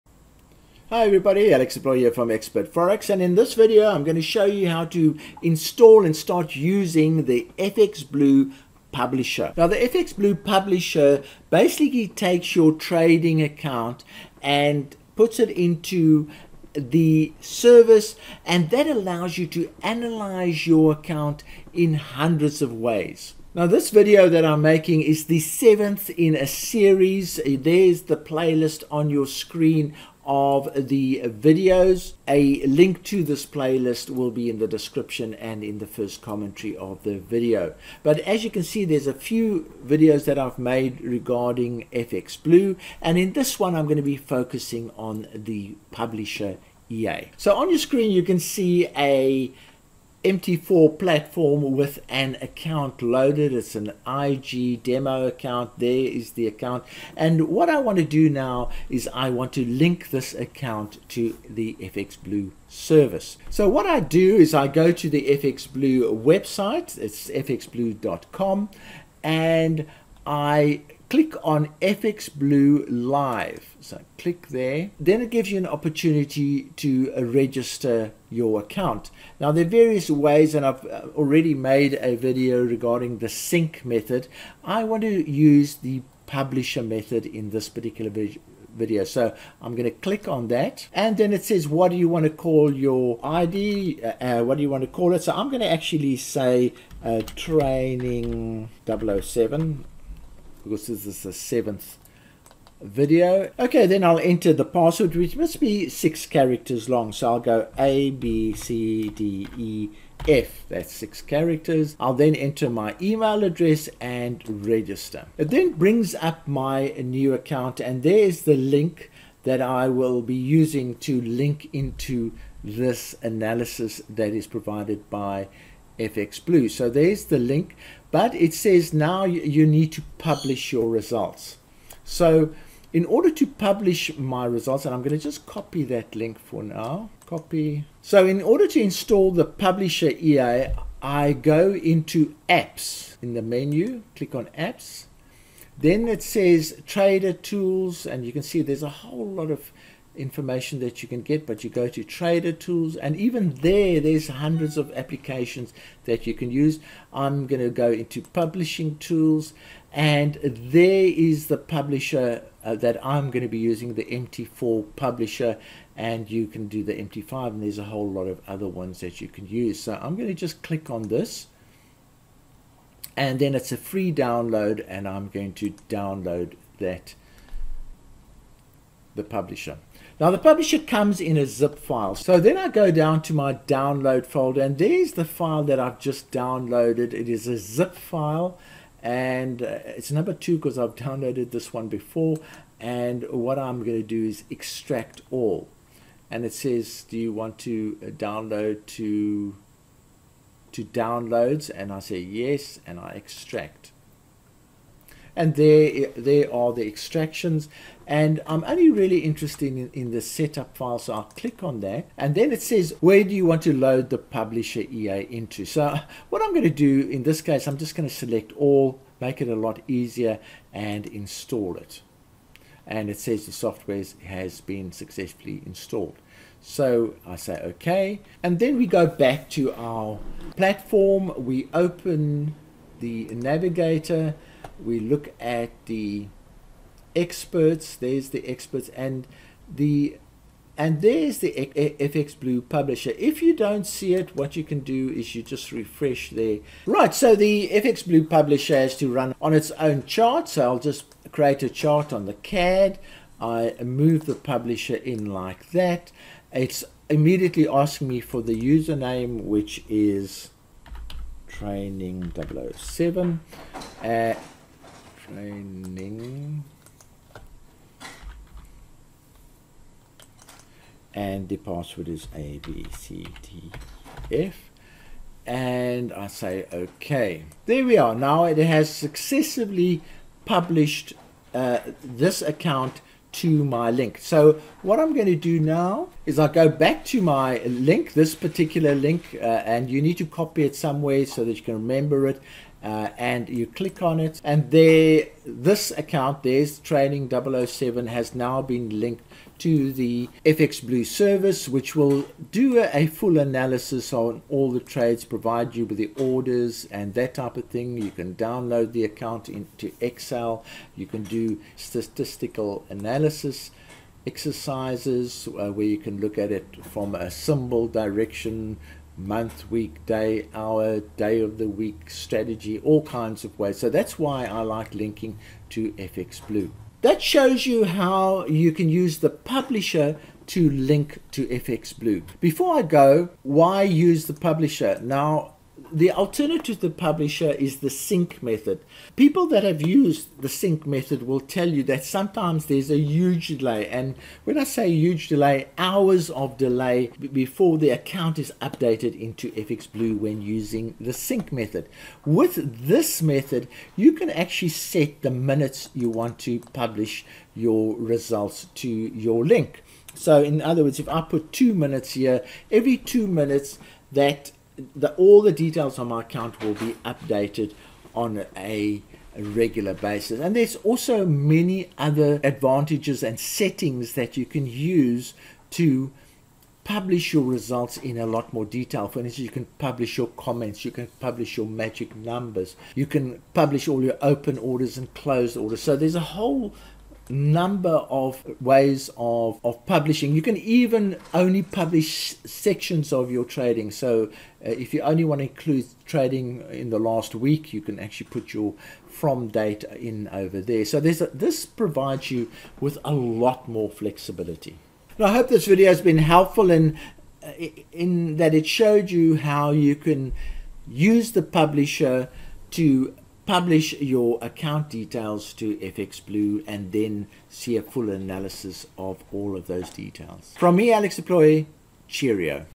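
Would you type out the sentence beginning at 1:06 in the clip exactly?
It's fxblue.com and I click on FX Blue Live.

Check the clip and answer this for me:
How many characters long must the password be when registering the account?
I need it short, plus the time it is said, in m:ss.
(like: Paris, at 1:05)
6, at 1:45.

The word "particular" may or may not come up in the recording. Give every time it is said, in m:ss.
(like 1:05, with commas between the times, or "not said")
1:27, 4:48.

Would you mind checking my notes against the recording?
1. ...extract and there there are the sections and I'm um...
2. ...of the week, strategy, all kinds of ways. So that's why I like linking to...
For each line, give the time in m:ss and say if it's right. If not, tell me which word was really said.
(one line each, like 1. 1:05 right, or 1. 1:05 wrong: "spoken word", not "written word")
1. 3:23 wrong: "extractions", not "sections"
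2. 5:21 right.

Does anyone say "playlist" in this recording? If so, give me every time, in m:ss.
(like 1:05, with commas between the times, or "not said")
0:28, 0:33.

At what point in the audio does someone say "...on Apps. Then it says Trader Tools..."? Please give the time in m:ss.
2:24.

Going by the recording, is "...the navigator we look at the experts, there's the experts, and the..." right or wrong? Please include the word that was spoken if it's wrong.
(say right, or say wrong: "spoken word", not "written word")
right.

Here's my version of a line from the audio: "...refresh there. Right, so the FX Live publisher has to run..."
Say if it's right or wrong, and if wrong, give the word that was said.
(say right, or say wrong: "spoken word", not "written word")
wrong: "Blue", not "Live".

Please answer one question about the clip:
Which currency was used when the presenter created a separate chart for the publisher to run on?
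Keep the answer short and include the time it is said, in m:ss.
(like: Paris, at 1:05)
CAD, at 4:12.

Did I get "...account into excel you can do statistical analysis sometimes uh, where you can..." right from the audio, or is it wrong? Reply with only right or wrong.
wrong.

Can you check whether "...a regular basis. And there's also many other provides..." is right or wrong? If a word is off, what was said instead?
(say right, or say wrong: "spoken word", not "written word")
wrong: "advantages", not "provides".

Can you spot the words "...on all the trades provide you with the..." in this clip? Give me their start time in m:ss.
5:04.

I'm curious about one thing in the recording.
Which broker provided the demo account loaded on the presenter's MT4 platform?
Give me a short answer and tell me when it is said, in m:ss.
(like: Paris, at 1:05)
IG, at 0:54.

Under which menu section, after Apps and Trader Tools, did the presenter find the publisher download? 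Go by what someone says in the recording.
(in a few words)
publishing tools.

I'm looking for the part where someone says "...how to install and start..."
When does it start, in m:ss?
0:04.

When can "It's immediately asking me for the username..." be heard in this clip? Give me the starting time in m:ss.
4:16.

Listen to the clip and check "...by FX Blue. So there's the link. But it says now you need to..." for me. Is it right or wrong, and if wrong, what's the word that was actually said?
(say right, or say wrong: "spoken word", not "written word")
right.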